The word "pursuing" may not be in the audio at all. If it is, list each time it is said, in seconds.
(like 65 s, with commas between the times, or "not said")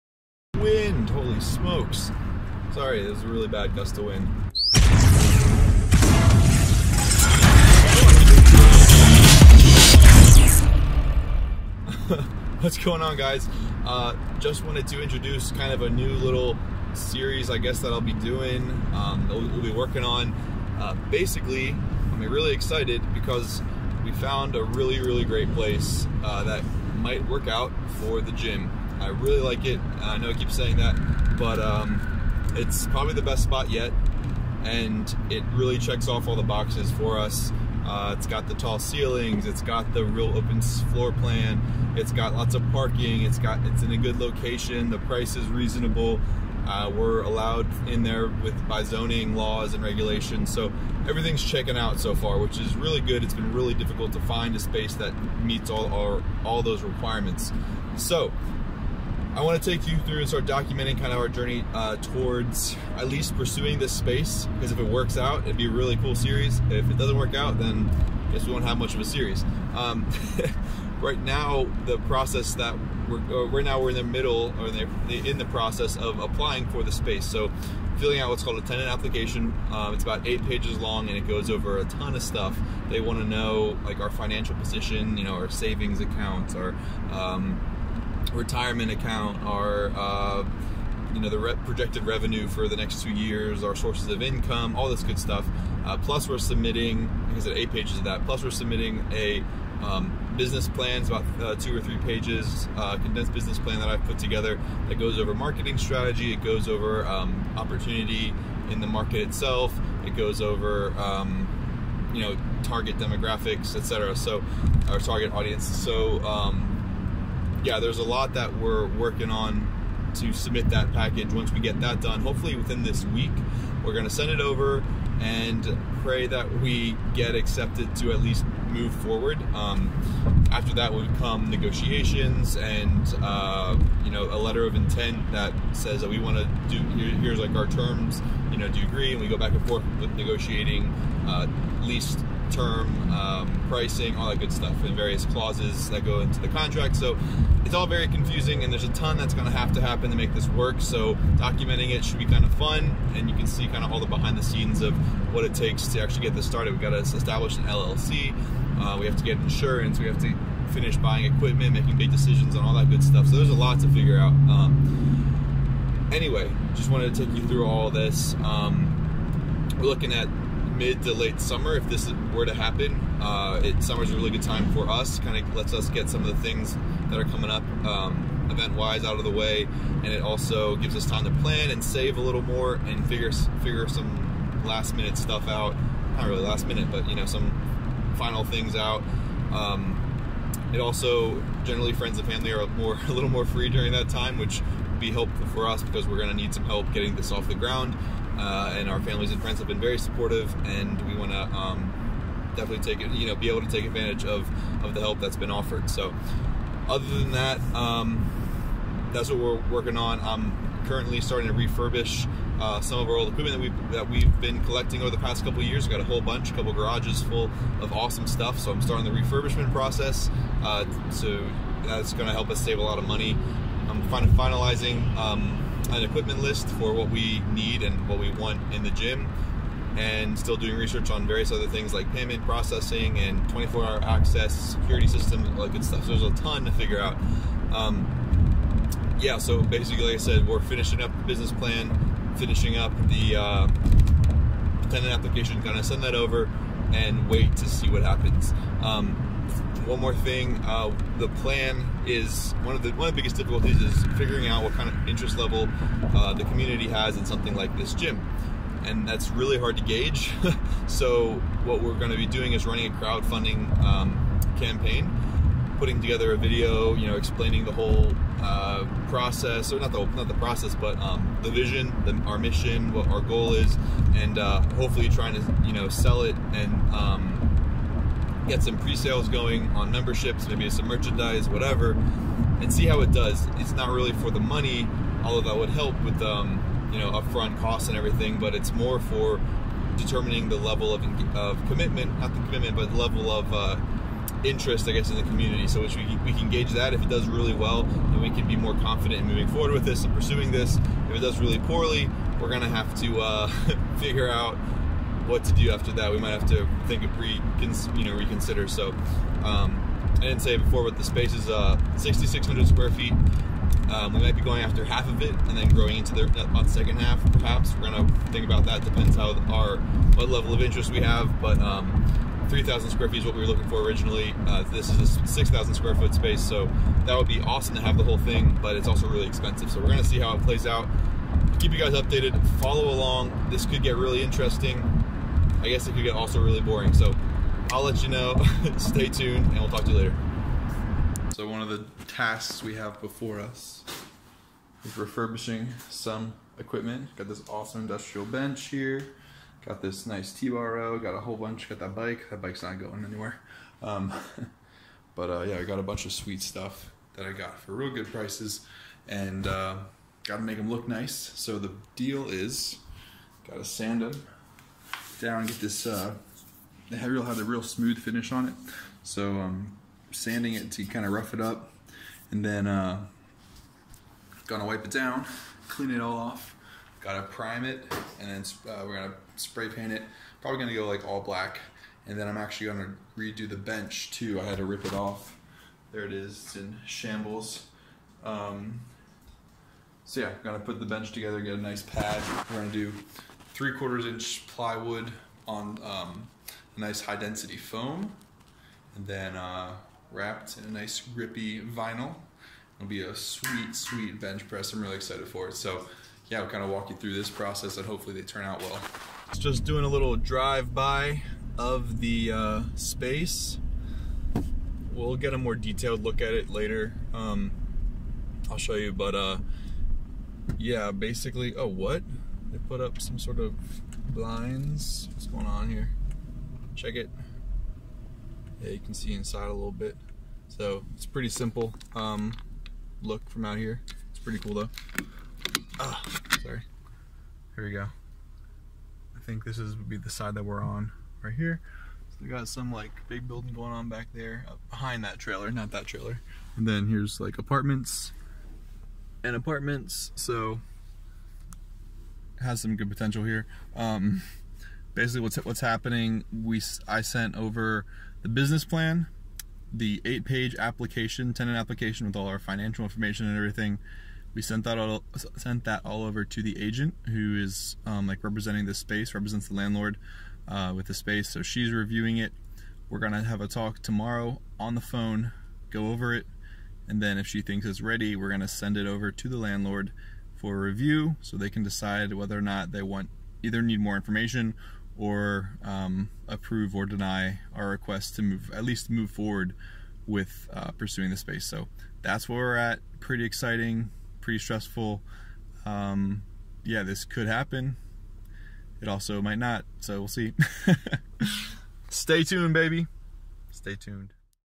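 63 s, 300 s, 490 s.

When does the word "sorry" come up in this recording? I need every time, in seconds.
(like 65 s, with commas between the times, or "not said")
2 s, 436 s.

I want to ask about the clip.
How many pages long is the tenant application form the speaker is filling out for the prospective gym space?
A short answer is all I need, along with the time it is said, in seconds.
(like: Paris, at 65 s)
8, at 79 s.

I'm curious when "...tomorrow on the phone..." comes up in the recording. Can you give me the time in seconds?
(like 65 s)
473 s.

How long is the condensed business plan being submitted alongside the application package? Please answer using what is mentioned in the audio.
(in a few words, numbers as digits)
2 or 3 pages.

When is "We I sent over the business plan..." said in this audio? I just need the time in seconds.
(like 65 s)
456 s.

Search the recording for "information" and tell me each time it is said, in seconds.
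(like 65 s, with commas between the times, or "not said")
462 s, 483 s.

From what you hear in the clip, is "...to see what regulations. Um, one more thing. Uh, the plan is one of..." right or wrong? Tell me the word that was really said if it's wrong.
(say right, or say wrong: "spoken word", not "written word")
wrong: "happens", not "regulations".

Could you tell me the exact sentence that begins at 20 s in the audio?
Uh, basically, I'm really excited because we found a really, really great place uh, that might work out for the gym.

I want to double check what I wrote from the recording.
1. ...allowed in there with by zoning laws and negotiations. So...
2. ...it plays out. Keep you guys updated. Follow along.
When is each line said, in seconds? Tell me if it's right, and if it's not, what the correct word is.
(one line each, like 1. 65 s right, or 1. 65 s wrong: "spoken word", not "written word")
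1. 47 s wrong: "regulations", not "negotiations"
2. 330 s right.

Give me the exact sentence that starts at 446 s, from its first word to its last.
And then here's like apartments and apartments.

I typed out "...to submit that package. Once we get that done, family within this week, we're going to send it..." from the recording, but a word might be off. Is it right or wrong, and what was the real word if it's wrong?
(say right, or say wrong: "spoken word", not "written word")
wrong: "hopefully", not "family".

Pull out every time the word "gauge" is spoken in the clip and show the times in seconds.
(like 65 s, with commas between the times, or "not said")
259 s, 296 s.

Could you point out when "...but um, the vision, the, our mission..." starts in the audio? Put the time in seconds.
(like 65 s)
270 s.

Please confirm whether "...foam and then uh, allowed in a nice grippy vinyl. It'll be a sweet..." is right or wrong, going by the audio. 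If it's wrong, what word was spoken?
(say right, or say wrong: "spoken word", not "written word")
wrong: "wrapped", not "allowed".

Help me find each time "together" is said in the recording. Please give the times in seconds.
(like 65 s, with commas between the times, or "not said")
104 s, 266 s, 391 s.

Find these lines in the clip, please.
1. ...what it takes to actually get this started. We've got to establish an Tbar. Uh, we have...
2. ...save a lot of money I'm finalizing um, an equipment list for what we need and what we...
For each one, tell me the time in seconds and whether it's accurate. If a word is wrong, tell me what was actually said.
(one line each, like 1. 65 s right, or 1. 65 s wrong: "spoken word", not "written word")
1. 155 s wrong: "LLC", not "Tbar"
2. 222 s right.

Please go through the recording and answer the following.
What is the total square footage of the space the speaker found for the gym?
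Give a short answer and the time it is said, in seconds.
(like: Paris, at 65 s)
6,600 square feet, at 311 s.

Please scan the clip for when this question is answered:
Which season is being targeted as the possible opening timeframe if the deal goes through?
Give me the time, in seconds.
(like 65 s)
170 s.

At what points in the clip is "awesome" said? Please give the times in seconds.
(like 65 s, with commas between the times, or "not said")
217 s, 327 s, 347 s.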